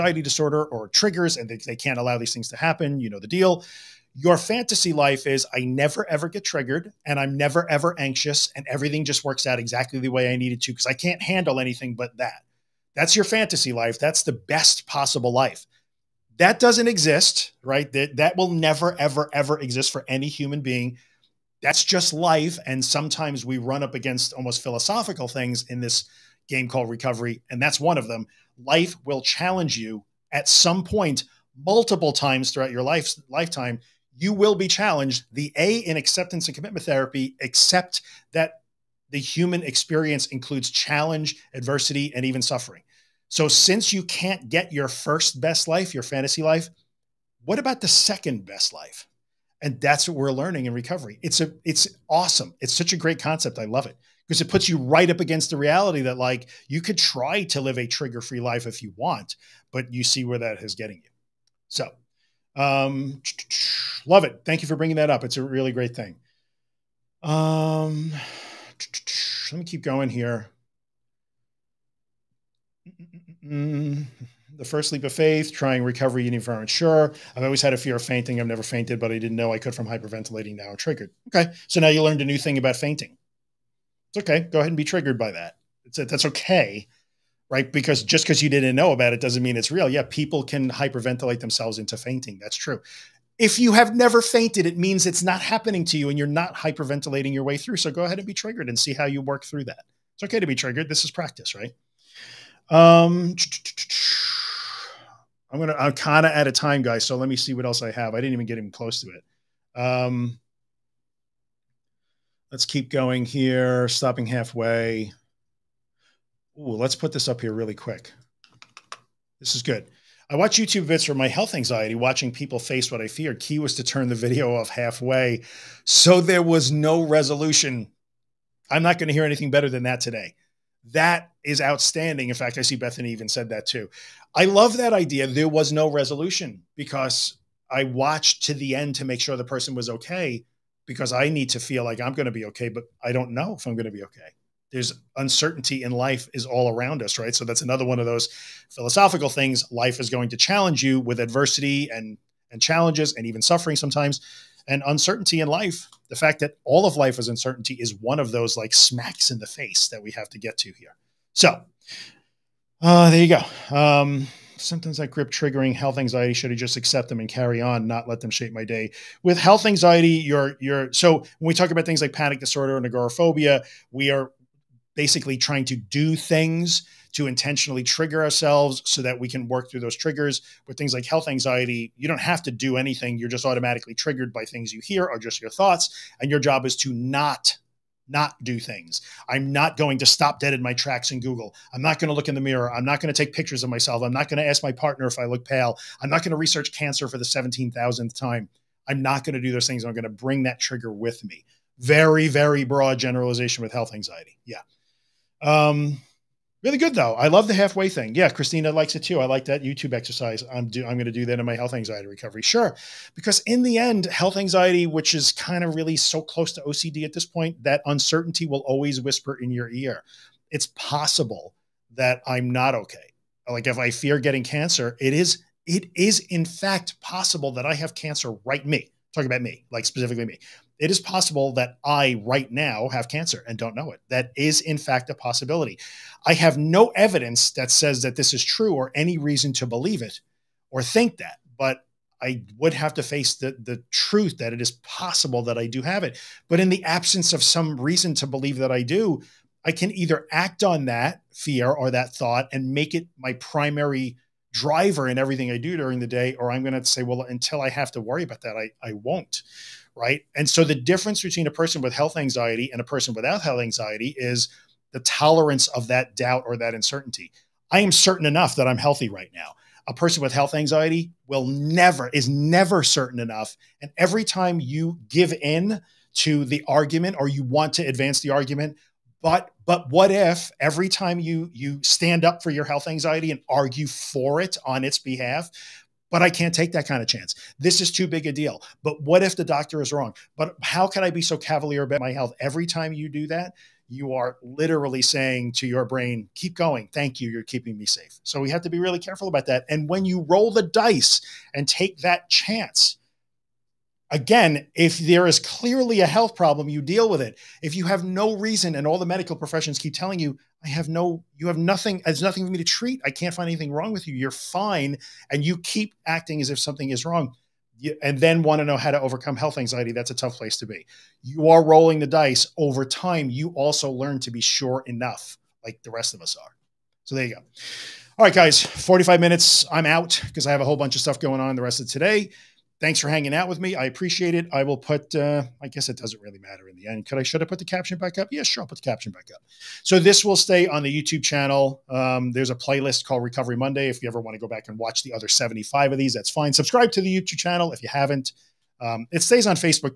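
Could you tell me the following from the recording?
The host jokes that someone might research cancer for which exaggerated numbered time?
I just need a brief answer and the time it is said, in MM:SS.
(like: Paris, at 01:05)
17,000th, at 03:17.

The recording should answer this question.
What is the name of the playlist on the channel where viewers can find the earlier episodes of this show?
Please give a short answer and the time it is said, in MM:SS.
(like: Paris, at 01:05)
Recovery Monday, at 05:43.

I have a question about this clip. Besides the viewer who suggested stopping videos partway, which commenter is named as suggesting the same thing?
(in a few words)
Bethany.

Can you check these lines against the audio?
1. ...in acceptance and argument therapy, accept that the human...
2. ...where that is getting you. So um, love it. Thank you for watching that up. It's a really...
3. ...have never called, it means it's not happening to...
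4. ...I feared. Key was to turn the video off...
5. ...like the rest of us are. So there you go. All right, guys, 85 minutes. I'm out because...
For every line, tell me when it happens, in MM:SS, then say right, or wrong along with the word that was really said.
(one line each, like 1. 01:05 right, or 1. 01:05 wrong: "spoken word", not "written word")
1. 00:35 wrong: "commitment", not "argument"
2. 01:00 wrong: "bringing", not "watching"
3. 01:33 wrong: "fainted", not "called"
4. 02:03 right
5. 05:25 wrong: "45", not "85".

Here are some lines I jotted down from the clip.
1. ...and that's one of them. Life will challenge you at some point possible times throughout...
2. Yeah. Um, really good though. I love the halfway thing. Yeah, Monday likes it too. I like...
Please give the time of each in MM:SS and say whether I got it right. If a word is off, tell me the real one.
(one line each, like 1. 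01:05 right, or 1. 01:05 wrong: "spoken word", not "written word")
1. 00:27 wrong: "multiple", not "possible"
2. 03:24 wrong: "Christina", not "Monday".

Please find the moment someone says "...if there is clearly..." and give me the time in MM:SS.
05:04.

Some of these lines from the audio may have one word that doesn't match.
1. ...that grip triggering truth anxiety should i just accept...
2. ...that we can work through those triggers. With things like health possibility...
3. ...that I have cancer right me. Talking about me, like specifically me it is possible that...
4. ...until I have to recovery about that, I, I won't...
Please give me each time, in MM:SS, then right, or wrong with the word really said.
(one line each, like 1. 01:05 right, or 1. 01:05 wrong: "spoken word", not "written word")
1. 02:44 wrong: "health", not "truth"
2. 02:59 wrong: "anxiety", not "possibility"
3. 03:47 right
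4. 04:17 wrong: "worry", not "recovery".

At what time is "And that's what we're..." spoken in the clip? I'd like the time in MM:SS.
00:49.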